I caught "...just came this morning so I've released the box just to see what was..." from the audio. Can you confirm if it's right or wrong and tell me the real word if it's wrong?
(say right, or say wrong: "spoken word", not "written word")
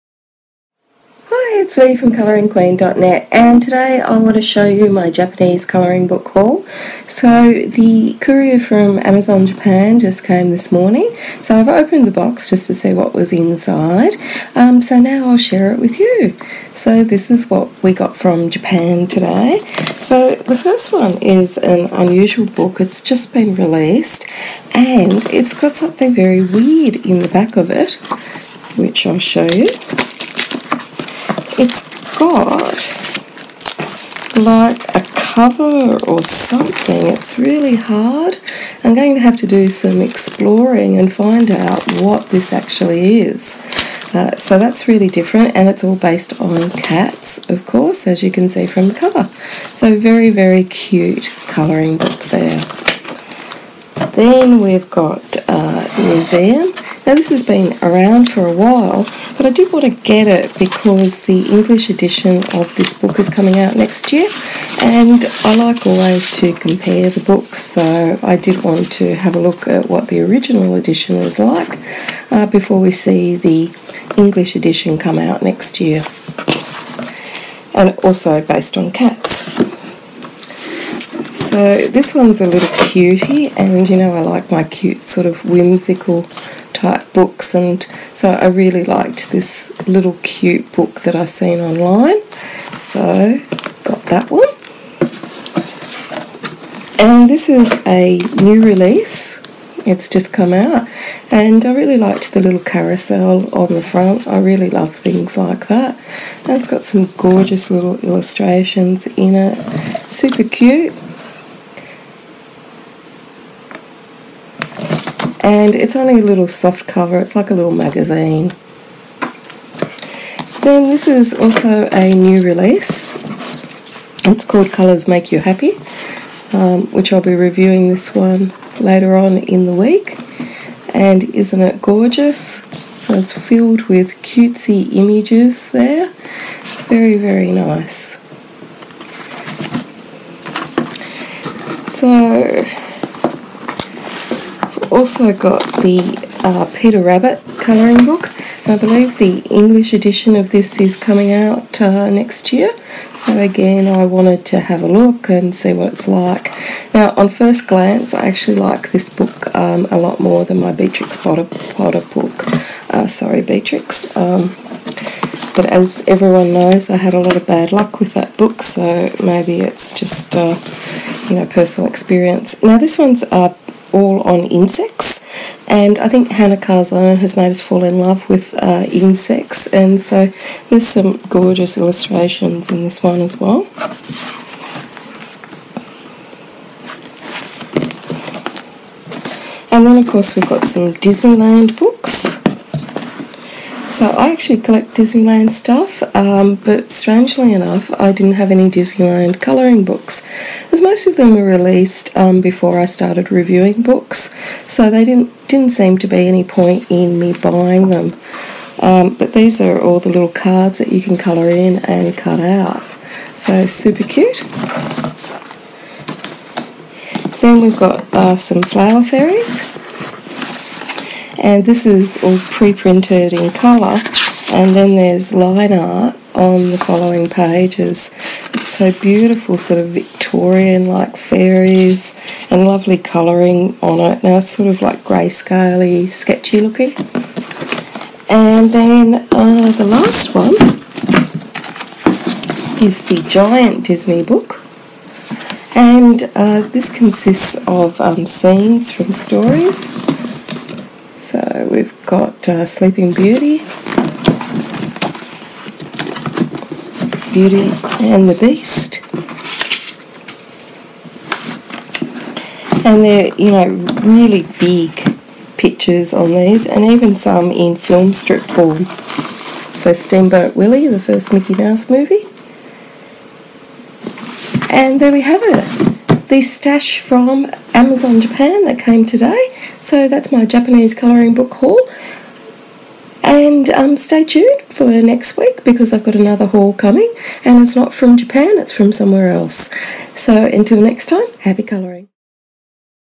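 wrong: "opened", not "released".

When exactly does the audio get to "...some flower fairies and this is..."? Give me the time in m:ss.
3:38.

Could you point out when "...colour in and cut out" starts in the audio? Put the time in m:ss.
3:31.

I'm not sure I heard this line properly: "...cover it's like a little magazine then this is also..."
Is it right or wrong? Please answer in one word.
right.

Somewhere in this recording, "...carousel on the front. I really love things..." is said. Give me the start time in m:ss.
1:42.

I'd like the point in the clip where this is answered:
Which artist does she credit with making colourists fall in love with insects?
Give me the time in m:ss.
2:56.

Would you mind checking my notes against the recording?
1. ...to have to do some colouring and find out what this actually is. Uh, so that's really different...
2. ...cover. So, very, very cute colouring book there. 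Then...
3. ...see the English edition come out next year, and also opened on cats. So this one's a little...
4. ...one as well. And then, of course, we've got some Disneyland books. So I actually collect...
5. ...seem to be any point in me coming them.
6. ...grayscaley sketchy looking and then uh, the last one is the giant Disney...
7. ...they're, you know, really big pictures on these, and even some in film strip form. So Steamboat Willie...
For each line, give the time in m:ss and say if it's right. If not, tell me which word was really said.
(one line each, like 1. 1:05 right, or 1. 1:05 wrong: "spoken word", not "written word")
1. 0:39 wrong: "exploring", not "colouring"
2. 0:48 right
3. 1:12 wrong: "based", not "opened"
4. 3:03 right
5. 3:25 wrong: "buying", not "coming"
6. 3:54 right
7. 4:23 right.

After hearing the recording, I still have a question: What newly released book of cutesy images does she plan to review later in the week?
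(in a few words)
Colors Make You Happy.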